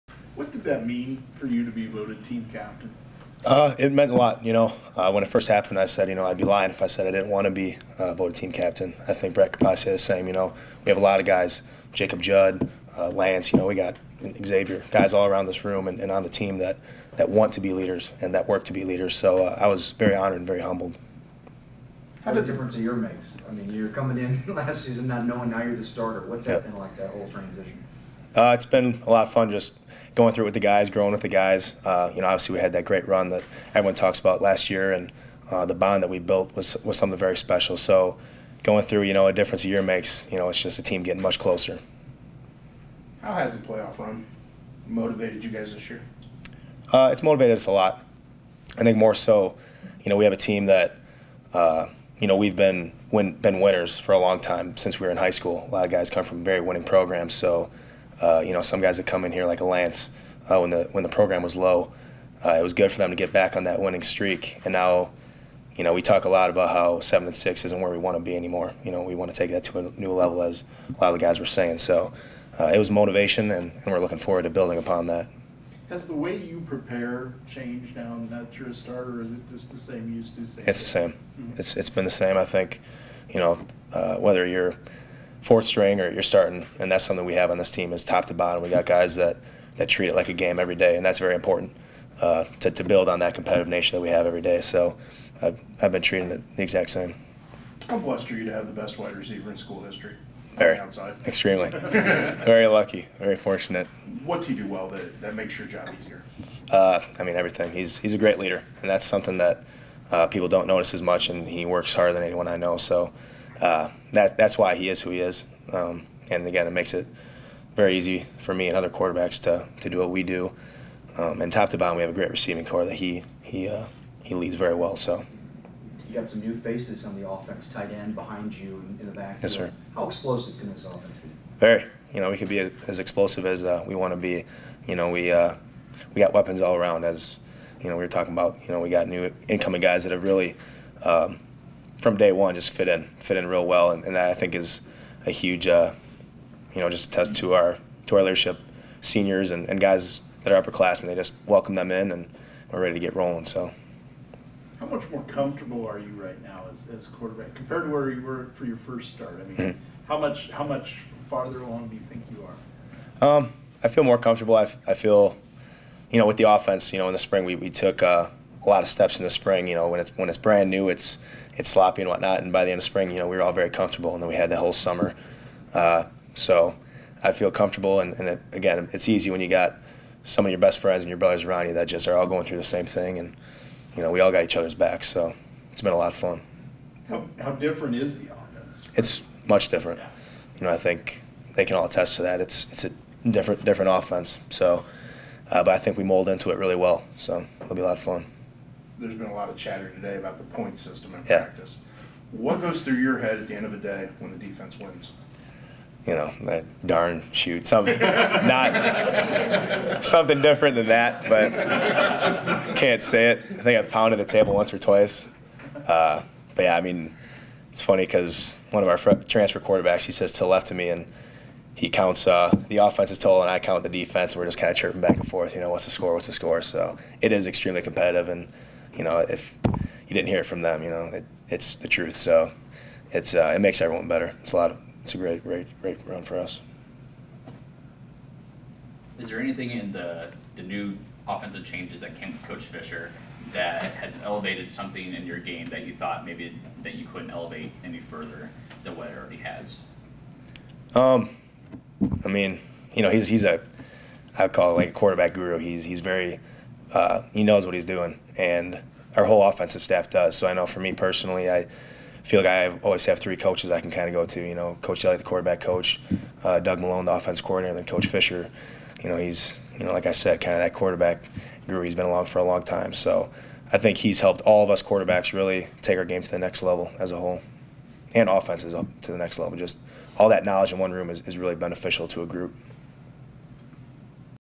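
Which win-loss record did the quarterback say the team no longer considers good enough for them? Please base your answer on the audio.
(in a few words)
7-6.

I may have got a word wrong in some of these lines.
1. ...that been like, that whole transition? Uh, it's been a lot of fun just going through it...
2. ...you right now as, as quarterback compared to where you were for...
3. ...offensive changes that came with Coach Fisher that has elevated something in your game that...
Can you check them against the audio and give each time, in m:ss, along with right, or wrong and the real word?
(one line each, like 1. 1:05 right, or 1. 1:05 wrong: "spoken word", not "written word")
1. 0:26 right
2. 2:35 right
3. 4:01 right.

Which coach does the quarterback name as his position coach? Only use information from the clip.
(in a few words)
Coach Elliott.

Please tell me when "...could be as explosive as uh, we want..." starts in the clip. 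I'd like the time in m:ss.
2:12.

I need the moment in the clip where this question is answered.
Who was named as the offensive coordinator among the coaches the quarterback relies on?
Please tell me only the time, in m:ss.
4:26.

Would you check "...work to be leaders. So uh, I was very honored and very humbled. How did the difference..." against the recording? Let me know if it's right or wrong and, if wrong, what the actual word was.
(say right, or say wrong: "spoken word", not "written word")
right.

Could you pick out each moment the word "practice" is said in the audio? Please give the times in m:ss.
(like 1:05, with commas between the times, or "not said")
3:21.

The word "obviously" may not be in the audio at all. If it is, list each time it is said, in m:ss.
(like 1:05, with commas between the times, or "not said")
0:32.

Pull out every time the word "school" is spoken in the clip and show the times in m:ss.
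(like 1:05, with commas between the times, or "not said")
0:55, 1:39.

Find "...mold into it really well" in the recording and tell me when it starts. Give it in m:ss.
3:16.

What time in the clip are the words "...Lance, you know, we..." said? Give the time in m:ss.
0:13.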